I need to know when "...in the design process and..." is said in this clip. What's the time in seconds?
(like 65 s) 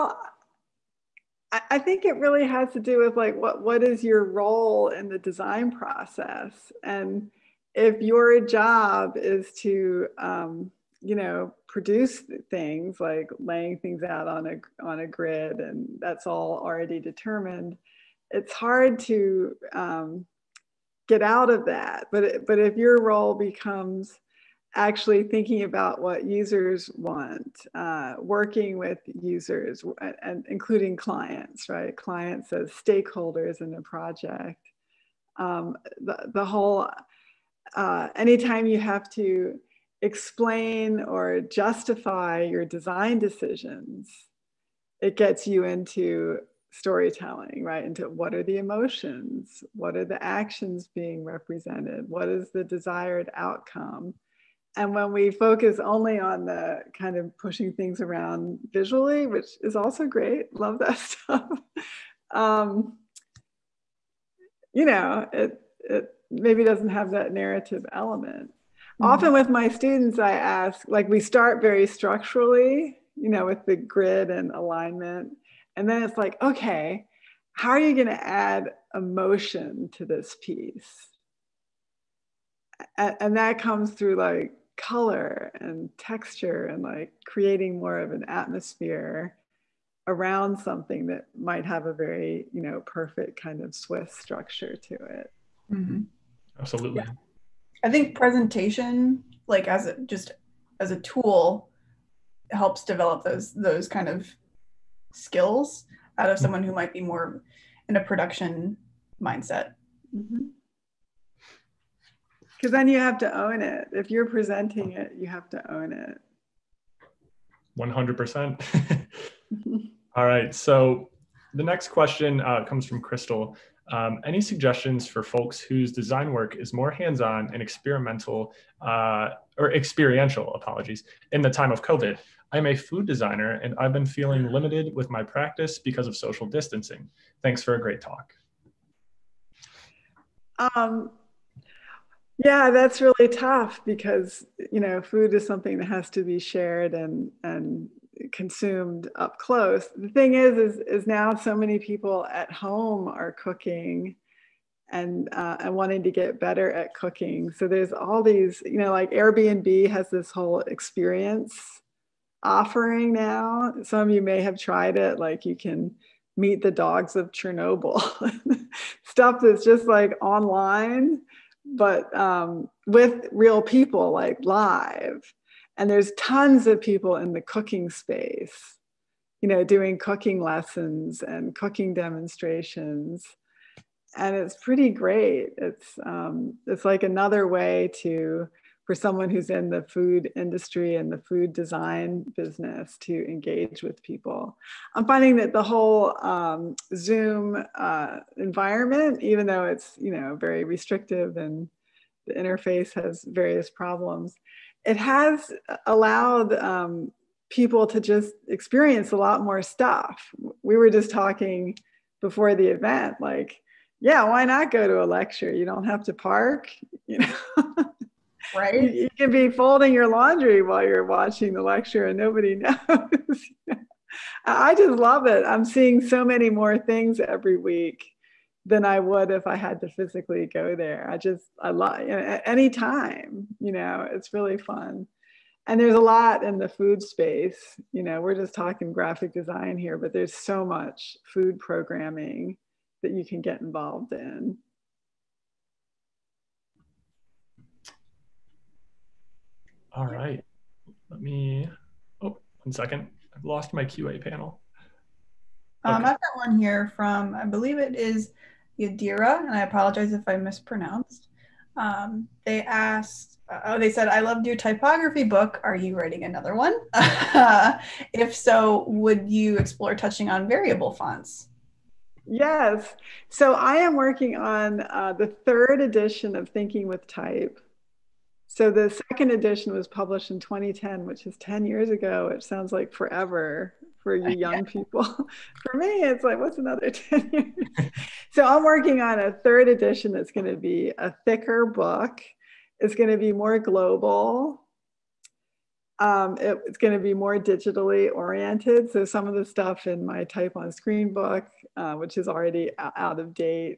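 4 s.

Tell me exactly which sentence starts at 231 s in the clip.
I just, I love, you know, at any time, you know, it's really fun.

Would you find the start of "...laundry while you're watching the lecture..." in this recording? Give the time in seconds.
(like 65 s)
220 s.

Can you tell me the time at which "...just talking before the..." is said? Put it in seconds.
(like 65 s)
210 s.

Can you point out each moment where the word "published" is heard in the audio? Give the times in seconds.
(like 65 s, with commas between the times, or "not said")
279 s.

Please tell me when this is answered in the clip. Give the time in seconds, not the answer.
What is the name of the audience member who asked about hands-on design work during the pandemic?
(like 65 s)
123 s.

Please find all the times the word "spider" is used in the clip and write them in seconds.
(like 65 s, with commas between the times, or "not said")
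not said.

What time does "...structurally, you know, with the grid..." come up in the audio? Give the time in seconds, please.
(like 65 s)
71 s.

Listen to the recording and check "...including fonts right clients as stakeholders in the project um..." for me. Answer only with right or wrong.
wrong.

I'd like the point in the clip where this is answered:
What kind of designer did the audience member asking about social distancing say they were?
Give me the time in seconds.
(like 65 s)
132 s.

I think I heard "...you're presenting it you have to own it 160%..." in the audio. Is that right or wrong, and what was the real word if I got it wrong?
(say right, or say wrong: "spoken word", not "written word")
wrong: "100", not "160".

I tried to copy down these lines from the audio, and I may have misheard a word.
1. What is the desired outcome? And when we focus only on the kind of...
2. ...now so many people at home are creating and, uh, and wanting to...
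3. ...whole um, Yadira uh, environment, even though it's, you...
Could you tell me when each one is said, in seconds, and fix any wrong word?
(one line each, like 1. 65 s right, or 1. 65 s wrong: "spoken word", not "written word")
1. 52 s right
2. 151 s wrong: "cooking", not "creating"
3. 195 s wrong: "Zoom", not "Yadira".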